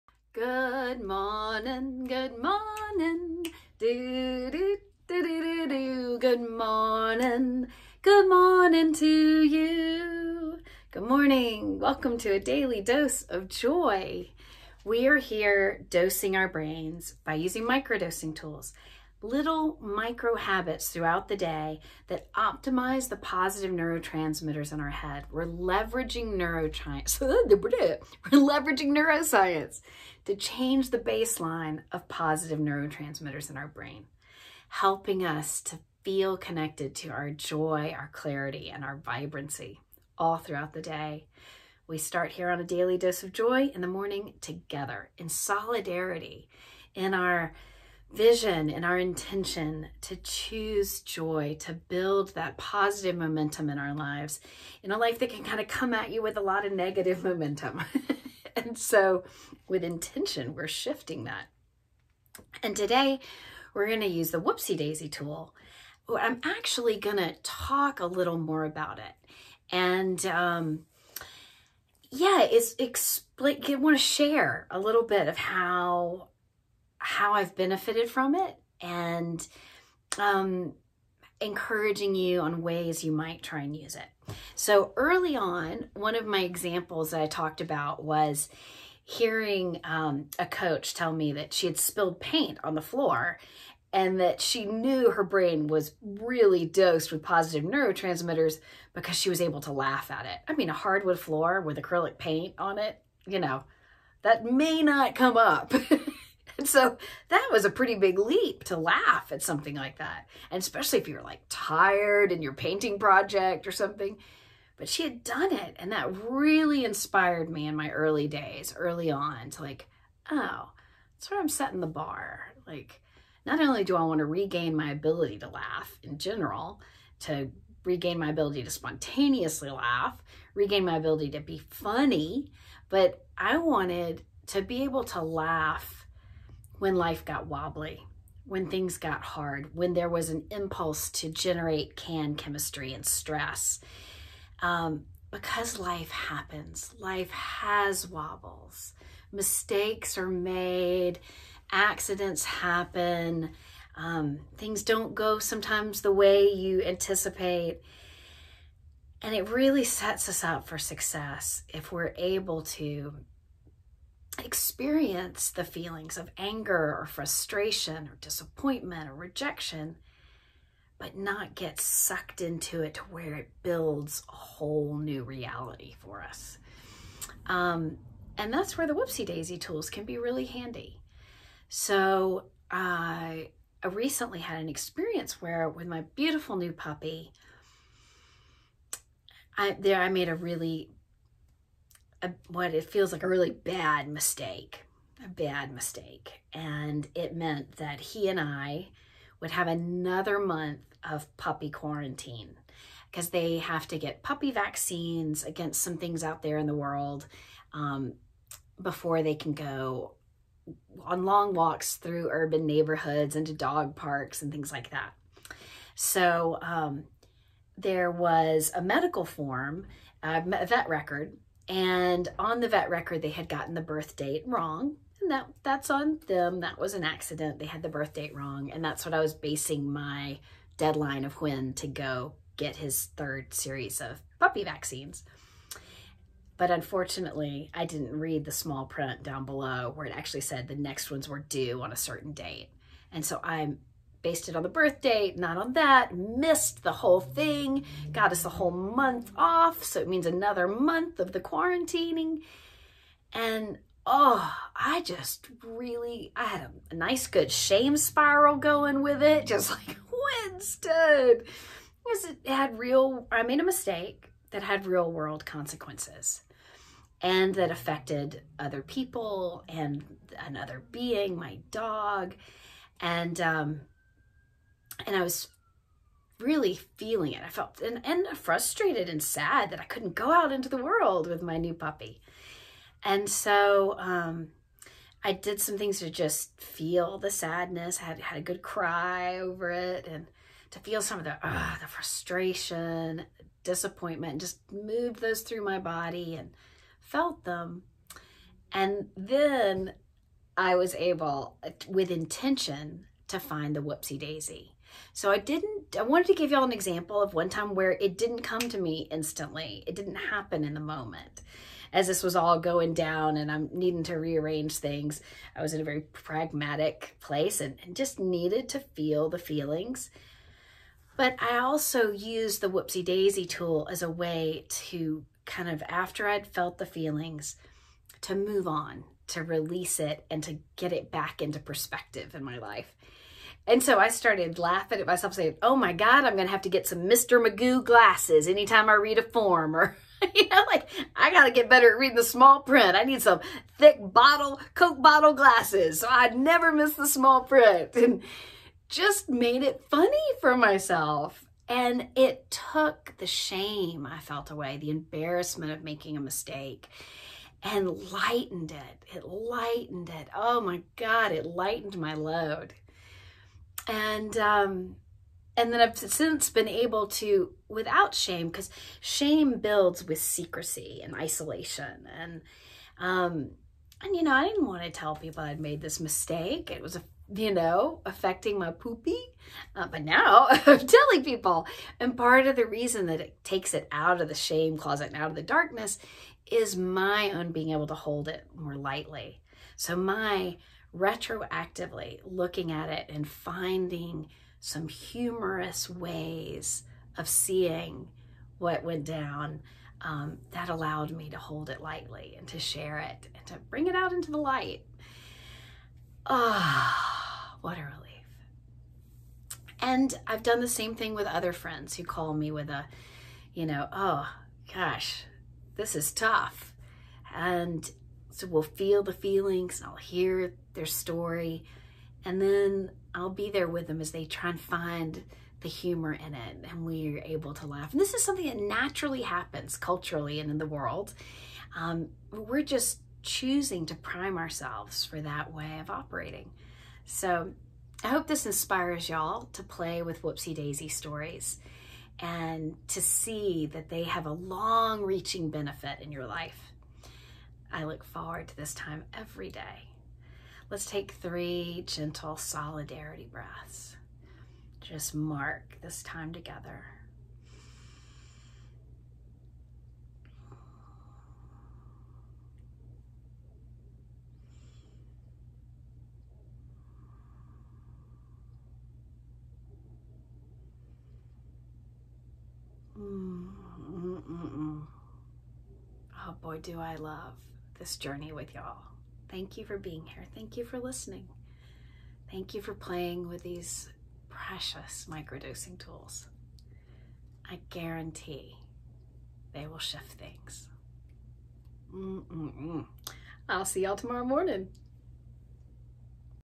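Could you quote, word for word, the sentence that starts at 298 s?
And then I was able, with intention, to find the whoopsie daisy.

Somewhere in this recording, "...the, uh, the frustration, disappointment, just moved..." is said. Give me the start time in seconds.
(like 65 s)
291 s.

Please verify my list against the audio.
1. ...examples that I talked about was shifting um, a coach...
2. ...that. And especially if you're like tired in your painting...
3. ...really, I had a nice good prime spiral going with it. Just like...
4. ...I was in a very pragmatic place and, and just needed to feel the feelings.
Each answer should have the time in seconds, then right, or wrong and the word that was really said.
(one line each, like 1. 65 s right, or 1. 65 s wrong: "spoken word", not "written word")
1. 86 s wrong: "hearing", not "shifting"
2. 109 s right
3. 255 s wrong: "shame", not "prime"
4. 315 s right.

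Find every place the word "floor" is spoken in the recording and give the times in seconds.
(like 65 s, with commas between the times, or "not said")
92 s, 101 s.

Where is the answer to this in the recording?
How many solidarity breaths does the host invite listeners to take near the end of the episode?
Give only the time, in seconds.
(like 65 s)
451 s.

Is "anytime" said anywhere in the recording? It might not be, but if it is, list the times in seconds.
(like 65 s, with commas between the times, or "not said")
338 s.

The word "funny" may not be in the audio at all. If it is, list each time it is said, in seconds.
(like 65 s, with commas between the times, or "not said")
131 s, 349 s.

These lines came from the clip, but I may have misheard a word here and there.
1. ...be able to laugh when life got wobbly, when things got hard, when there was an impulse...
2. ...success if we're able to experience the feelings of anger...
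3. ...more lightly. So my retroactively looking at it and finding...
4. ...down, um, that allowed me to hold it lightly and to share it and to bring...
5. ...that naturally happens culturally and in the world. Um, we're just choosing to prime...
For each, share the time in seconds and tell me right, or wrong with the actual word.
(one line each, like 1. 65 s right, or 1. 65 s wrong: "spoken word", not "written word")
1. 134 s right
2. 160 s right
3. 388 s right
4. 399 s right
5. 428 s right.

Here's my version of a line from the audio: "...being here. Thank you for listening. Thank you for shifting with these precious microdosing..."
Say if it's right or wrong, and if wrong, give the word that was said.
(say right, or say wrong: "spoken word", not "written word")
wrong: "playing", not "shifting".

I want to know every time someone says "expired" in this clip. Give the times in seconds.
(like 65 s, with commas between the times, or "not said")
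not said.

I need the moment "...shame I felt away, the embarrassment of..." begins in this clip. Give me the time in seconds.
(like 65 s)
353 s.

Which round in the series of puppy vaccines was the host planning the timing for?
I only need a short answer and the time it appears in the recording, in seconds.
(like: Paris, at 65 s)
third, at 233 s.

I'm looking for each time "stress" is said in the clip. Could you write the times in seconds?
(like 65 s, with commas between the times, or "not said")
143 s.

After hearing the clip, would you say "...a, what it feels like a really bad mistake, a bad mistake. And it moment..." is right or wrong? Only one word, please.
wrong.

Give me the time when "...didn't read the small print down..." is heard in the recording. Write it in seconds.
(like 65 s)
237 s.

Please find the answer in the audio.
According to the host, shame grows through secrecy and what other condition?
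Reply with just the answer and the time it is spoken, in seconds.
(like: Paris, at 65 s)
isolation, at 371 s.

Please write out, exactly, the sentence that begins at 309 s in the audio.
It didn't happen in the moment.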